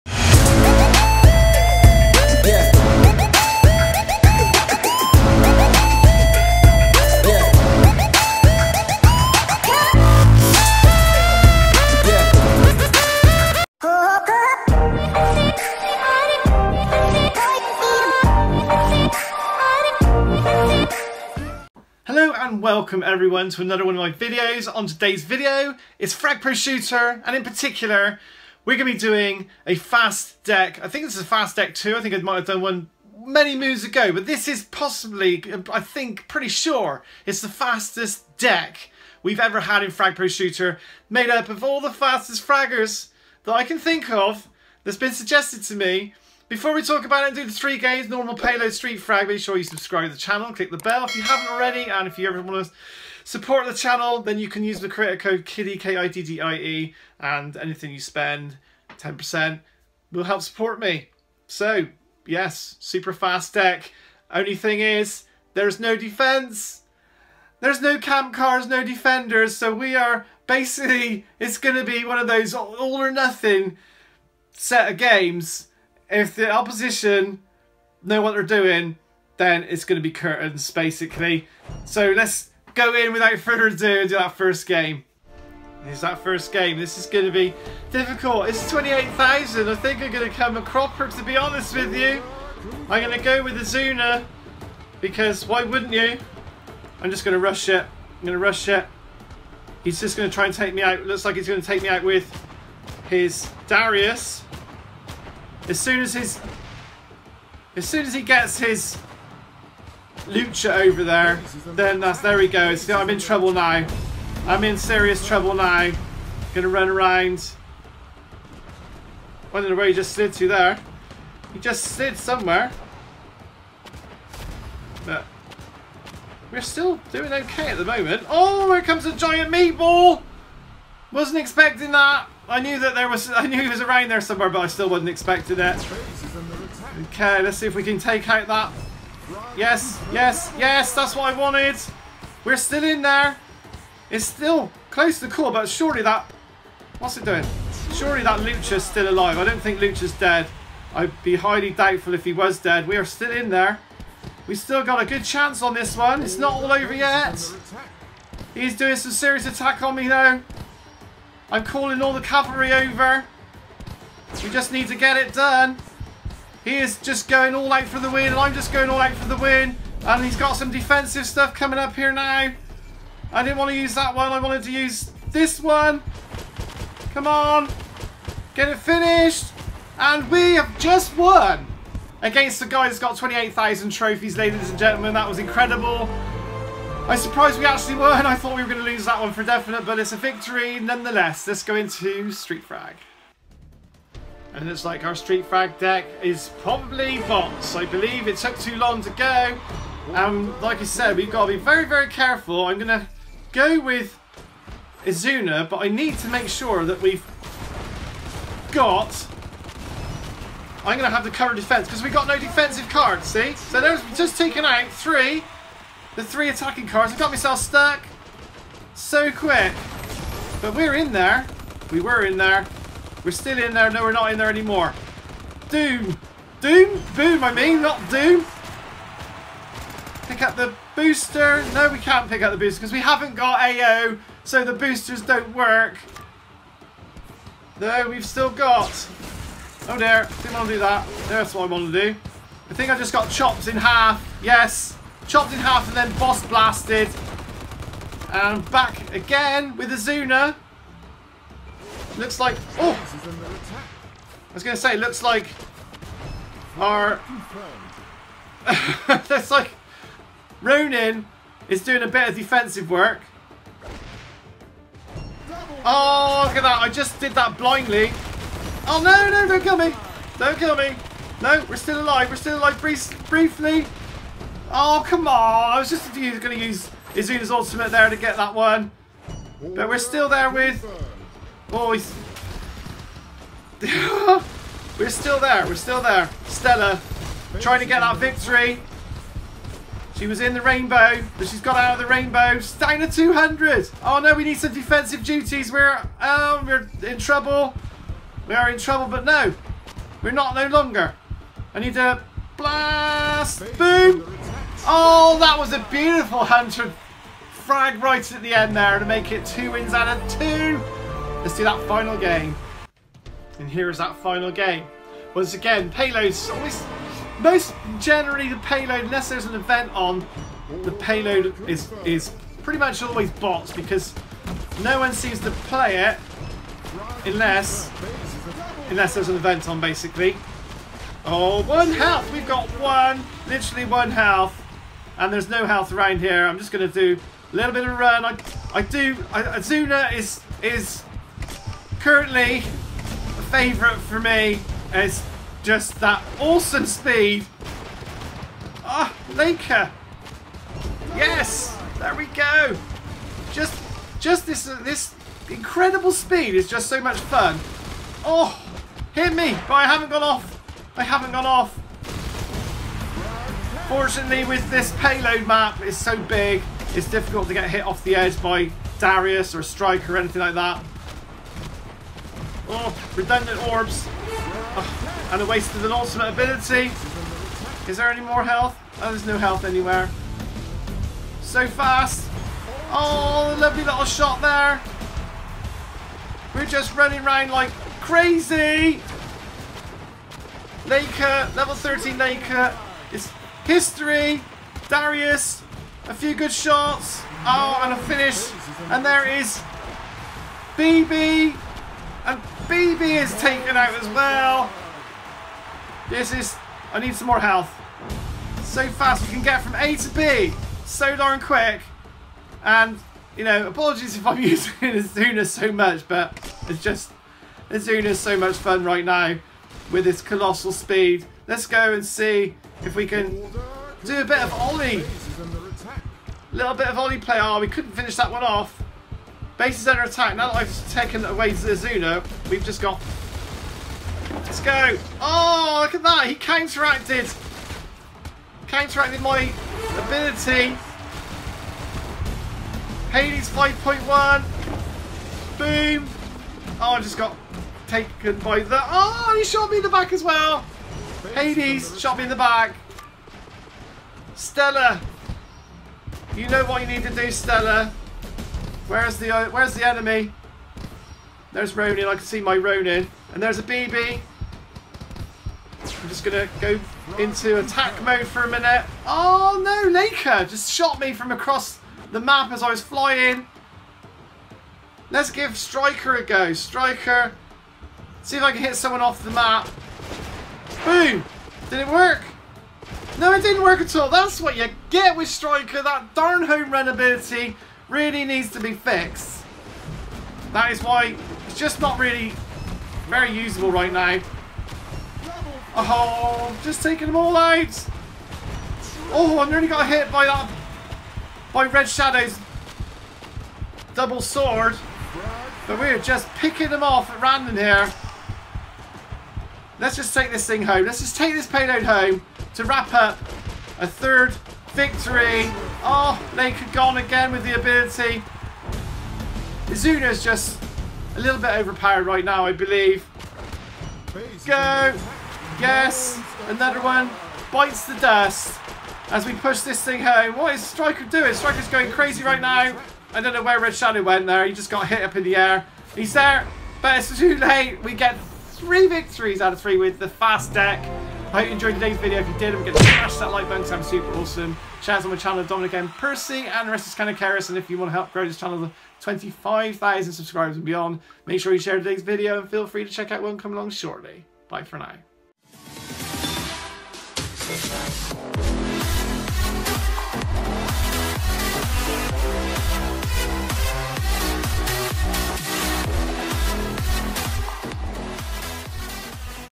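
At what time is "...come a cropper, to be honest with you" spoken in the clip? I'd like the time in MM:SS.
01:30.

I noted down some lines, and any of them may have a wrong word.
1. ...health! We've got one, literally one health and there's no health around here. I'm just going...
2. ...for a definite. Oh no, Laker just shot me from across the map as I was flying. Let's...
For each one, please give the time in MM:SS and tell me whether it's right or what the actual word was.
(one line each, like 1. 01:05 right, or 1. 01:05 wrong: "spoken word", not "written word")
1. 05:31 right
2. 07:48 wrong: "minute", not "definite".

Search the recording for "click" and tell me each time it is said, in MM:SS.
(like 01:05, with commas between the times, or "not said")
00:50.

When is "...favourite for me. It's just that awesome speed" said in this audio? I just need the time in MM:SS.
05:43.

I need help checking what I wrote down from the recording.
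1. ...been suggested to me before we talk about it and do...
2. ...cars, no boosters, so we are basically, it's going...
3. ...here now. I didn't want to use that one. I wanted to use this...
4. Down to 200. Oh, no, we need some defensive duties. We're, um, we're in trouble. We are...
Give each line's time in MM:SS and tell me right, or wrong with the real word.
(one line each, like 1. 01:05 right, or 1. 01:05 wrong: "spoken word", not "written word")
1. 00:44 right
2. 01:08 wrong: "defenders", not "boosters"
3. 02:51 right
4. 04:52 right.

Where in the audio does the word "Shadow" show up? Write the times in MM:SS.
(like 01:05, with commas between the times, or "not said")
08:21, 08:53.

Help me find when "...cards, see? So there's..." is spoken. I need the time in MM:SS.
03:32.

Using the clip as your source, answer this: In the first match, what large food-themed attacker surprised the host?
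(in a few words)
giant meatball.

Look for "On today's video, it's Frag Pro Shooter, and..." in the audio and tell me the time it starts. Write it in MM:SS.
00:24.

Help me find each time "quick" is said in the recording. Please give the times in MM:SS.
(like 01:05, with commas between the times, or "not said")
03:39, 06:51.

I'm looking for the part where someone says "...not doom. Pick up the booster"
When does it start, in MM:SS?
03:47.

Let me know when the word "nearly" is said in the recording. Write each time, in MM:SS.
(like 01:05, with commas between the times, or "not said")
08:19.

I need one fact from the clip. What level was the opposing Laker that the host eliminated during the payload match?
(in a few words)
13.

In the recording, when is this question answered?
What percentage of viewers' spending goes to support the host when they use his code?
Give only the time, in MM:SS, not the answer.
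00:58.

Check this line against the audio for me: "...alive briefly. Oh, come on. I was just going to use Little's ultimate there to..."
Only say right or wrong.
wrong.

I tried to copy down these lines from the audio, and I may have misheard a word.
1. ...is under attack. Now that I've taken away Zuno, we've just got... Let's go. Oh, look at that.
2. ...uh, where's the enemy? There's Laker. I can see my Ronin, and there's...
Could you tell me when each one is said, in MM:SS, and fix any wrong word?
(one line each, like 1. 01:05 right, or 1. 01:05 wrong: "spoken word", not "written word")
1. 07:09 right
2. 07:39 wrong: "Ronin", not "Laker".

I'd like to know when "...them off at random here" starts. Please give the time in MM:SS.
08:26.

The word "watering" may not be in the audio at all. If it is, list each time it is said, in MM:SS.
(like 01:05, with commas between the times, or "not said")
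not said.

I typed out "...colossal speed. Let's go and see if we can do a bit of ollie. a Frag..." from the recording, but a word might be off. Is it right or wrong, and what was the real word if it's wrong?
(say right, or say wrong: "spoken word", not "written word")
wrong: "Little", not "Frag".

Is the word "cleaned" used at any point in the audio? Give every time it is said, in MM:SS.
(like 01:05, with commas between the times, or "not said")
not said.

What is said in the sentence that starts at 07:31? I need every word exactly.
Hades shot me in the back.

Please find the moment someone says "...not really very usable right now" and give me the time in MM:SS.
08:11.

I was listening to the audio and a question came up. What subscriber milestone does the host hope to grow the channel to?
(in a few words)
25,000.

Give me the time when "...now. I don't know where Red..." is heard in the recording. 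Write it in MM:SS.
08:52.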